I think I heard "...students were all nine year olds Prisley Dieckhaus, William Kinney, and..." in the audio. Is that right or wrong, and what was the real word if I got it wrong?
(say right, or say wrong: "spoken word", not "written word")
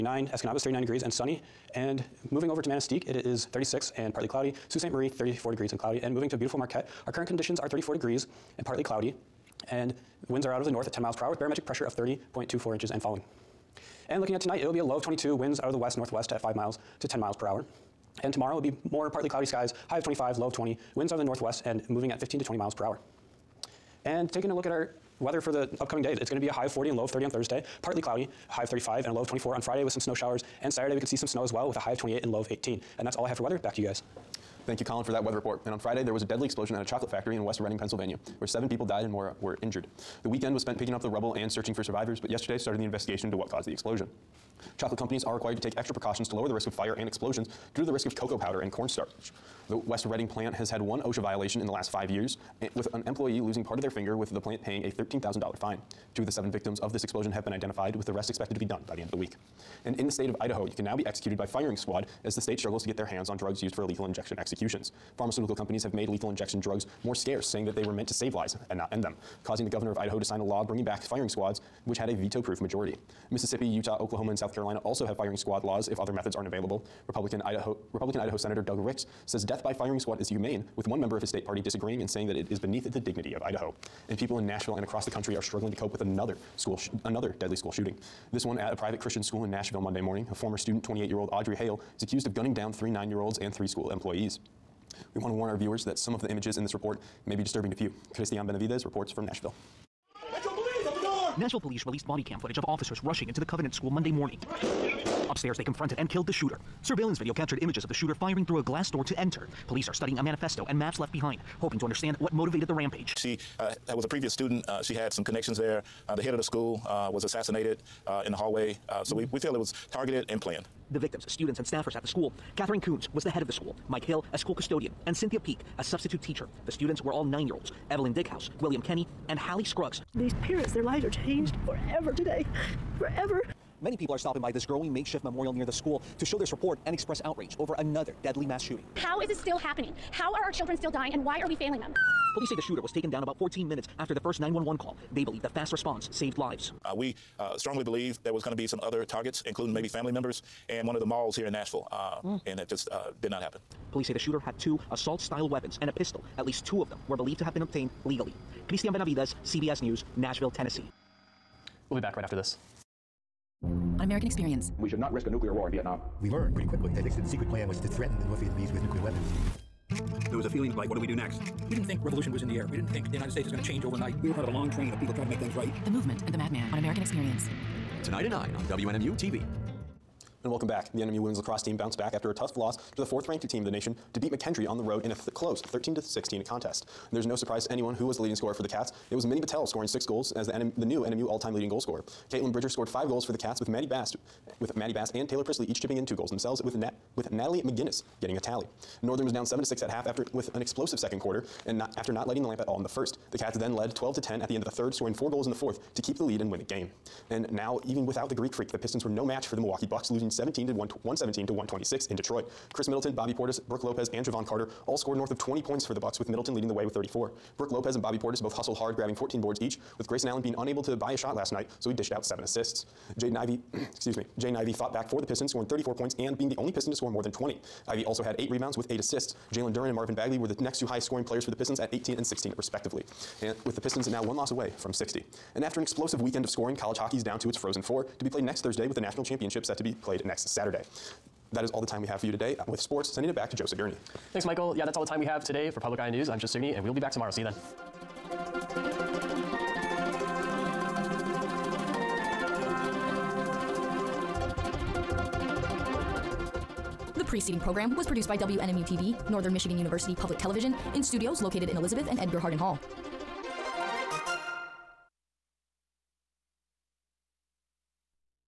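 wrong: "Evelyn", not "Prisley".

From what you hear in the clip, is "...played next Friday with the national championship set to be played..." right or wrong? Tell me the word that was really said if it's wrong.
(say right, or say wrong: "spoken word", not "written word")
wrong: "Thursday", not "Friday".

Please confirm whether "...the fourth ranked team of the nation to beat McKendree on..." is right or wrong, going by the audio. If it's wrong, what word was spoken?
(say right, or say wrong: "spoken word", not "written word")
right.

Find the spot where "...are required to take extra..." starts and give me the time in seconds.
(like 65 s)
45 s.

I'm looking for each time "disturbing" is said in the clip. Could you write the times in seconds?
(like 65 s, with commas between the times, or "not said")
97 s.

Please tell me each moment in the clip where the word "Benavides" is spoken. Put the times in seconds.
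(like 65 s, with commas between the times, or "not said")
98 s, 158 s.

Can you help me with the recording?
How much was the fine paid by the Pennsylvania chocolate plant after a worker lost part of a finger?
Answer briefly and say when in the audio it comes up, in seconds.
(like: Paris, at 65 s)
$13,000, at 54 s.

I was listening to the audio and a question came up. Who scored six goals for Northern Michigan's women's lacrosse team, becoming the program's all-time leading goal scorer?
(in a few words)
Minnie Battelle.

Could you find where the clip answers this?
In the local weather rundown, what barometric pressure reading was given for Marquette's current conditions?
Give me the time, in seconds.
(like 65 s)
11 s.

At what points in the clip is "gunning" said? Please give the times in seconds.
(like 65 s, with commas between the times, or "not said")
92 s.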